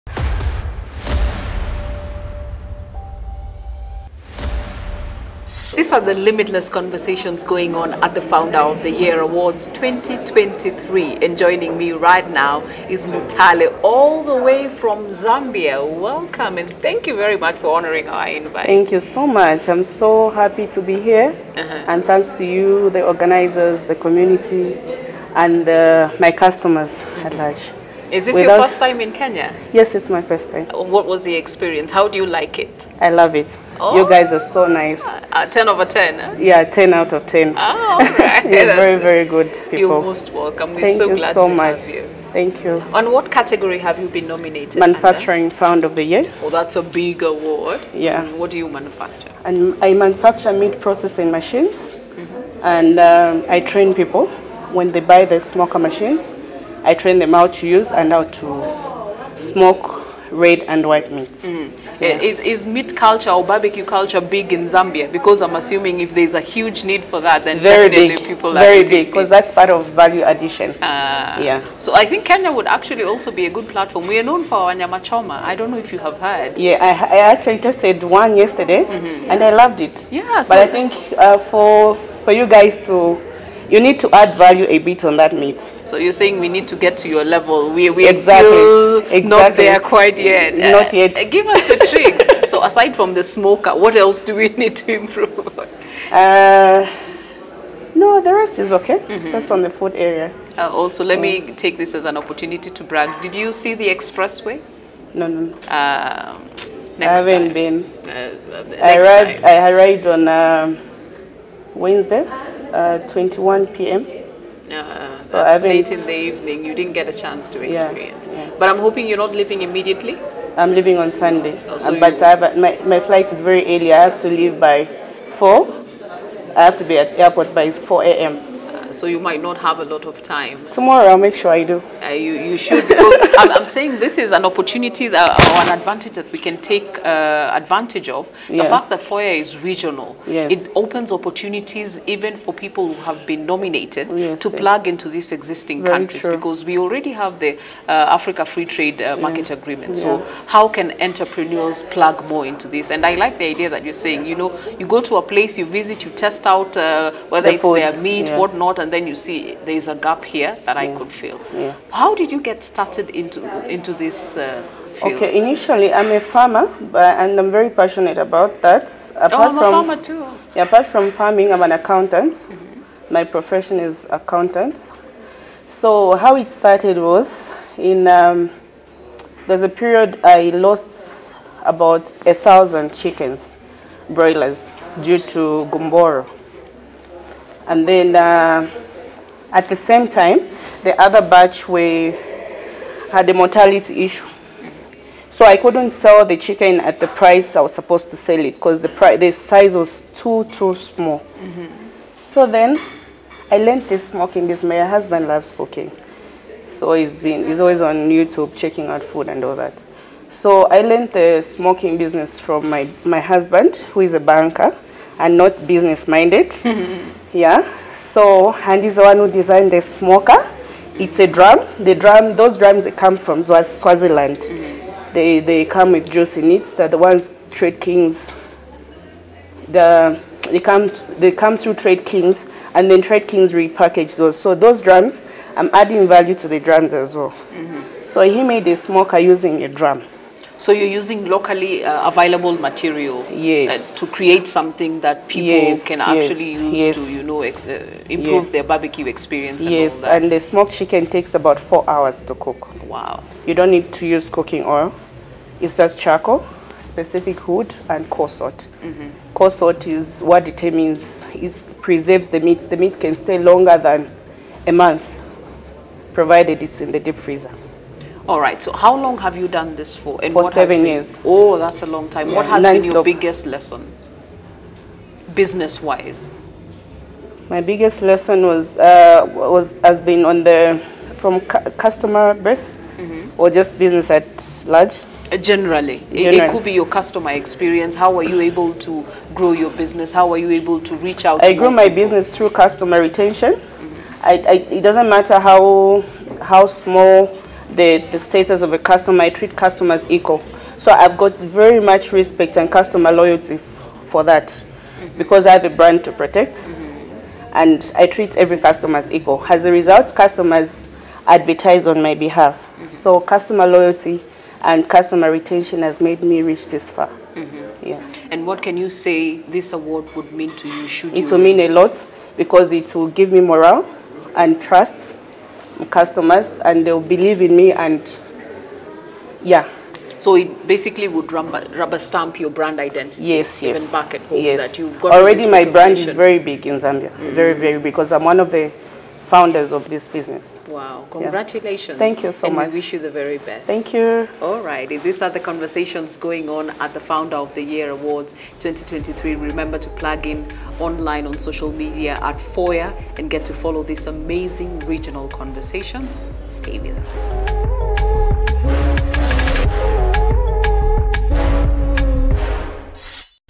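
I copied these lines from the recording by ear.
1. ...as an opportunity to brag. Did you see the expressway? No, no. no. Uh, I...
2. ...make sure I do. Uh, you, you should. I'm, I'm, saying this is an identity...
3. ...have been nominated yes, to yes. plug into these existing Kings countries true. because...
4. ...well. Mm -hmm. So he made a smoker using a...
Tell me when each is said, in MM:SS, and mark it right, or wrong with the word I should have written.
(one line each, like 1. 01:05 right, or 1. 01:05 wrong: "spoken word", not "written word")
1. 01:41 right
2. 02:11 wrong: "opportunity", not "identity"
3. 02:23 wrong: "Very", not "Kings"
4. 03:57 right.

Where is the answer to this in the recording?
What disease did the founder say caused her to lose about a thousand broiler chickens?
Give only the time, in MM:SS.
03:05.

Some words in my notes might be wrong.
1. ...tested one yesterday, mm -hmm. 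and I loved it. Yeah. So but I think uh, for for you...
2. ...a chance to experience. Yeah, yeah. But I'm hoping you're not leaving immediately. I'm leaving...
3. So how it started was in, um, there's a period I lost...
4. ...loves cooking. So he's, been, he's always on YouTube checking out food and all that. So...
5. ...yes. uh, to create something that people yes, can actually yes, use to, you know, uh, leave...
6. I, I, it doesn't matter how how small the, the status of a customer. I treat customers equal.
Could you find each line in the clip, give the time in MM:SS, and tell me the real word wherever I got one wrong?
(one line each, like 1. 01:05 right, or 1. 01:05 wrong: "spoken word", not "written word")
1. 01:17 right
2. 01:57 right
3. 02:55 right
4. 03:25 right
5. 04:03 wrong: "improve", not "leave"
6. 04:54 right.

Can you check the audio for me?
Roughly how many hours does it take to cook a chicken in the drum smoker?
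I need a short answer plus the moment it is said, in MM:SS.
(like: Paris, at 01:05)
4 hours, at 04:11.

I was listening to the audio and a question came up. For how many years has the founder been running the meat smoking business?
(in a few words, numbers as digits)
7 years.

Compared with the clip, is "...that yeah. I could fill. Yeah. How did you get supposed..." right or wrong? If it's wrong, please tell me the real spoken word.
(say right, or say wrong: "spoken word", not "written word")
wrong: "started", not "supposed".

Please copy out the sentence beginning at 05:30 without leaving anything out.
So it basically would rubber, rubber stamp your brand identity.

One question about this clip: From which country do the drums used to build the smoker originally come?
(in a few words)
Swaziland.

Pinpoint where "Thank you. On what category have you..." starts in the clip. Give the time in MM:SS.
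00:42.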